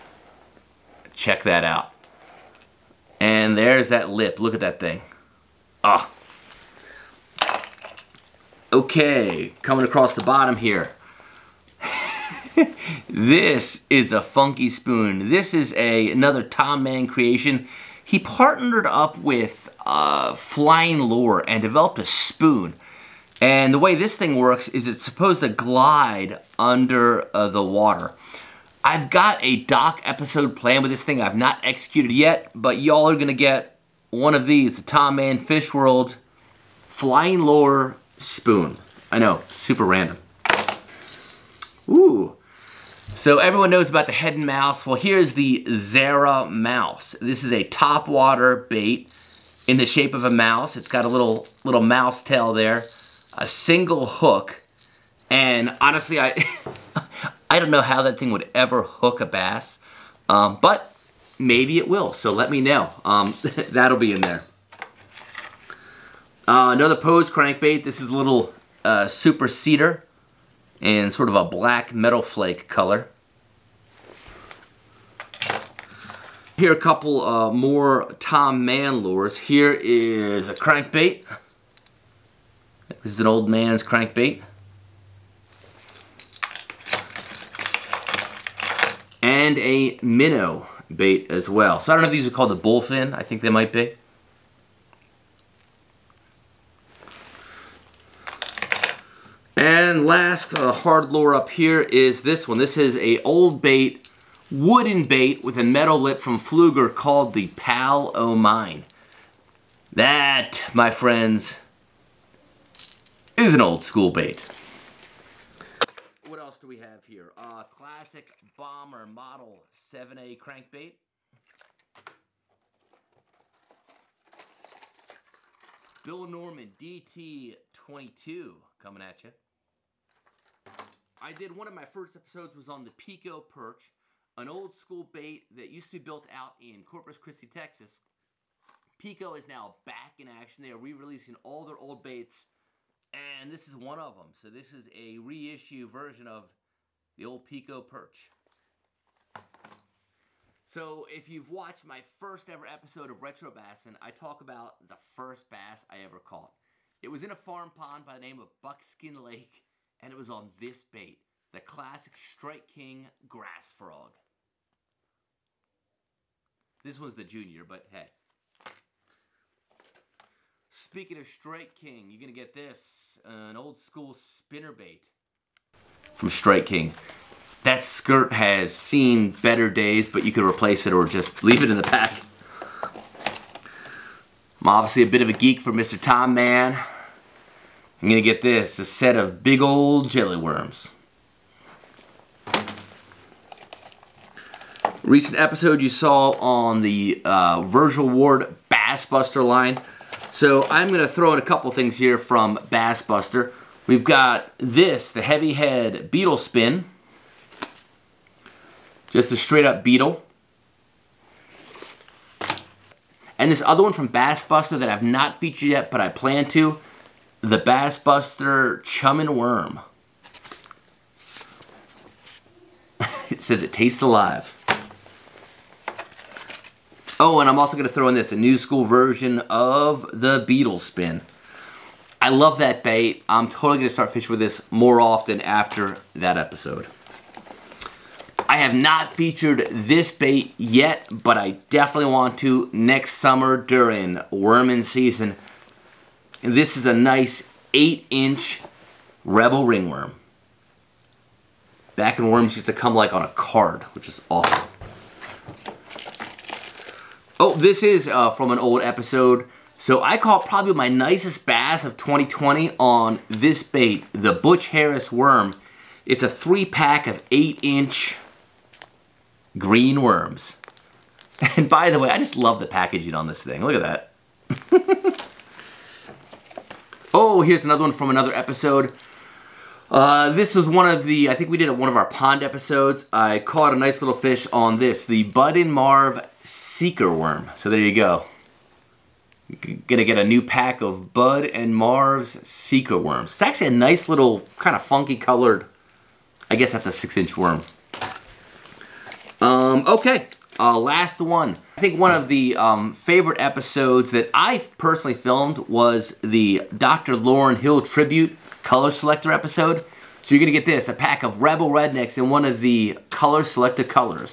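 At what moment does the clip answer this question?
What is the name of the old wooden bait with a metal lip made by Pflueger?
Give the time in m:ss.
1:47.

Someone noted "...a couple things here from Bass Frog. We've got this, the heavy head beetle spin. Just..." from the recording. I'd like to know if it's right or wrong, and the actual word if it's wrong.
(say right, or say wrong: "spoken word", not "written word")
wrong: "Buster", not "Frog".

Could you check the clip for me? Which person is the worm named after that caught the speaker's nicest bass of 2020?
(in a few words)
Butch Harris.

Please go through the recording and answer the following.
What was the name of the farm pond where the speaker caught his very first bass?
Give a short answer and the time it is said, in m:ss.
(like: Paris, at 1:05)
Buckskin Lake, at 2:38.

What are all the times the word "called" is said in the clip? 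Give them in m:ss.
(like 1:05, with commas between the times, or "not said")
1:32, 1:46.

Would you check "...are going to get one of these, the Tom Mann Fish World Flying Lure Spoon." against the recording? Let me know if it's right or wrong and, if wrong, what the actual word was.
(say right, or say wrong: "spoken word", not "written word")
right.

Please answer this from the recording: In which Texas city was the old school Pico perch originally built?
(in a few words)
Corpus Christi.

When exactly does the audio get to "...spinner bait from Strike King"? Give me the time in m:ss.
2:54.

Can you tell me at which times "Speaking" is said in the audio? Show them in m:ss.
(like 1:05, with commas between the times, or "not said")
2:50.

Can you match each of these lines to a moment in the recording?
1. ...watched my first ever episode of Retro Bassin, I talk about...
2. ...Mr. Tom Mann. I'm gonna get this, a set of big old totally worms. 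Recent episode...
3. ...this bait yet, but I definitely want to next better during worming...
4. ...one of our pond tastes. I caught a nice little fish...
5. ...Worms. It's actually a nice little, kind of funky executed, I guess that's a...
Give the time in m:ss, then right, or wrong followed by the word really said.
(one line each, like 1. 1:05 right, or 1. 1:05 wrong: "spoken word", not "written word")
1. 2:31 right
2. 3:05 wrong: "jelly", not "totally"
3. 3:59 wrong: "summer", not "better"
4. 4:41 wrong: "episodes", not "tastes"
5. 4:52 wrong: "colored", not "executed".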